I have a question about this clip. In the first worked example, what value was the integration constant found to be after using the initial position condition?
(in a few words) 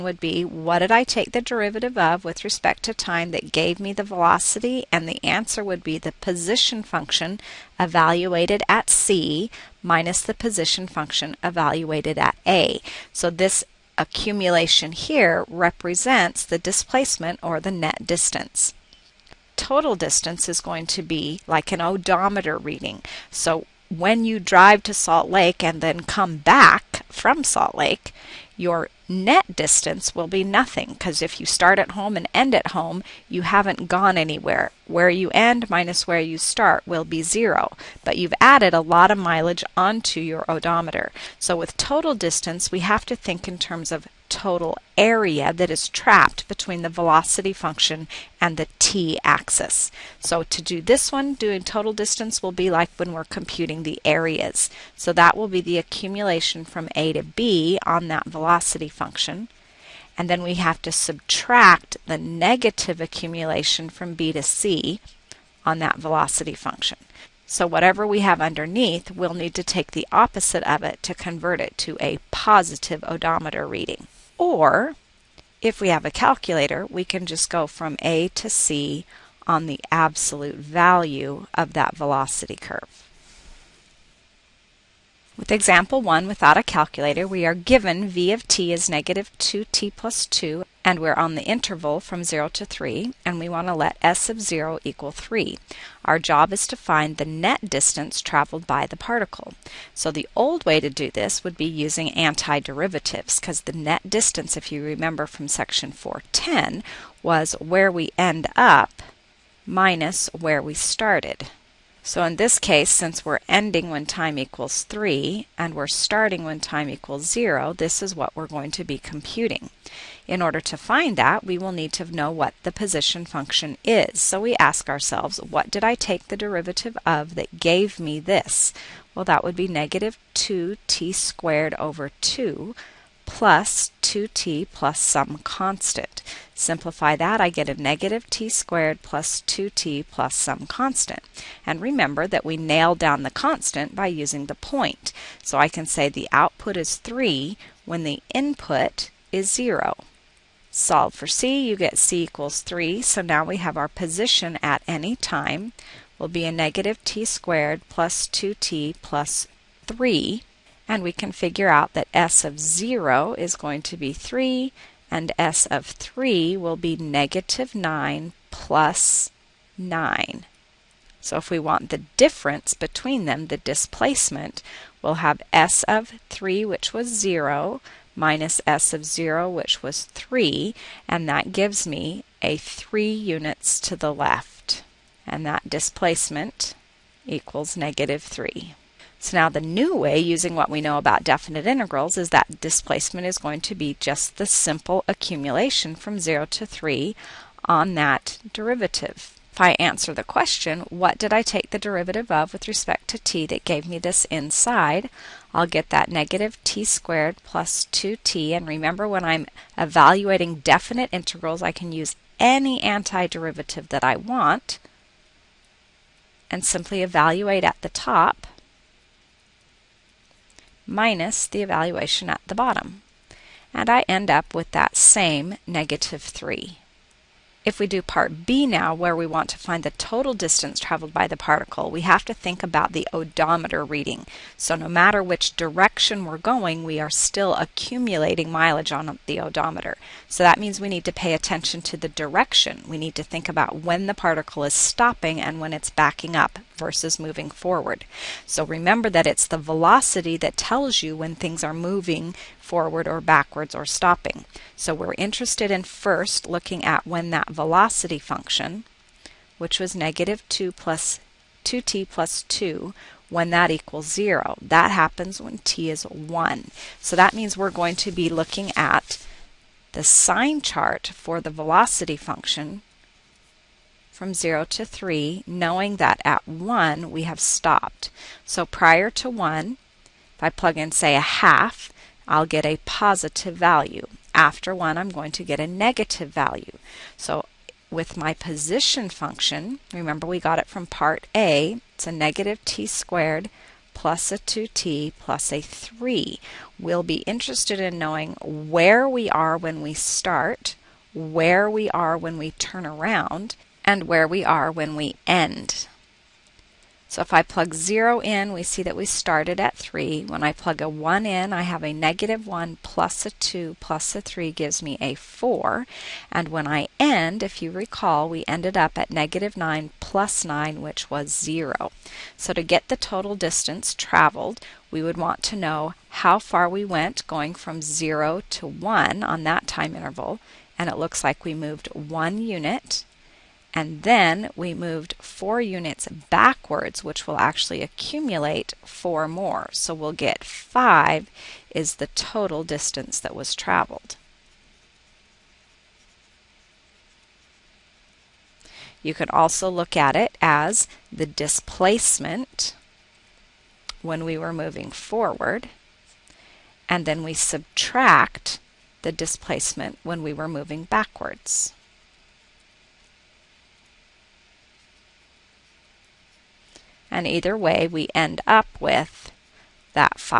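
3.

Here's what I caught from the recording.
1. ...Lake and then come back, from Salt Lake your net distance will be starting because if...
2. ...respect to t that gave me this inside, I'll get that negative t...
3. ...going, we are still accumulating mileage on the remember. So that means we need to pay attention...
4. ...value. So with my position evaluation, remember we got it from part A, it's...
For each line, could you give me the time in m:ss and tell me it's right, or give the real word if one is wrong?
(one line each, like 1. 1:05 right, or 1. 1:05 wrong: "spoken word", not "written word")
1. 0:25 wrong: "nothing", not "starting"
2. 3:22 right
3. 3:56 wrong: "odometer", not "remember"
4. 4:46 wrong: "function", not "evaluation".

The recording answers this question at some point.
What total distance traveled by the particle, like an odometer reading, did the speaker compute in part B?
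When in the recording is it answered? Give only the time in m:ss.
5:40.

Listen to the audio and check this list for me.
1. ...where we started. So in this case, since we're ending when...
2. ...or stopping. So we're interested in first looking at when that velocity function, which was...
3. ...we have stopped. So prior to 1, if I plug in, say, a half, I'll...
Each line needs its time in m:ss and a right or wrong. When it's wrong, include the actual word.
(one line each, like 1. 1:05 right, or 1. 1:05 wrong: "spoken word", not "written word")
1. 1:50 right
2. 4:13 right
3. 4:37 right.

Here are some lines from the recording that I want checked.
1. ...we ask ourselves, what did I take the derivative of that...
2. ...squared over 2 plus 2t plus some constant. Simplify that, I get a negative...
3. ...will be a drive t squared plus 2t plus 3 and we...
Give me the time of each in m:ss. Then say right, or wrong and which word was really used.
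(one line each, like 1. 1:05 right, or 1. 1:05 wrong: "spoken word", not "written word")
1. 2:04 right
2. 2:11 right
3. 2:36 wrong: "negative", not "drive".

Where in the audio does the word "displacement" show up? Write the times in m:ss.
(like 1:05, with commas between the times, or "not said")
0:16, 2:53, 3:05, 3:12, 5:51, 5:59.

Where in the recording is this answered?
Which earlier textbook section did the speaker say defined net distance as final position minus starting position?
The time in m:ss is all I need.
1:45.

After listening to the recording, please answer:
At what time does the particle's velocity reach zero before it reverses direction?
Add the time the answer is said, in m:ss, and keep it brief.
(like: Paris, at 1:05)
1, at 4:25.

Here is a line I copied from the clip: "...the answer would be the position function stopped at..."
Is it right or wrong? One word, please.
wrong.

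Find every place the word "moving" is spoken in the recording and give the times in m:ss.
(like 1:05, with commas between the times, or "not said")
4:07, 4:11, 5:54, 6:00.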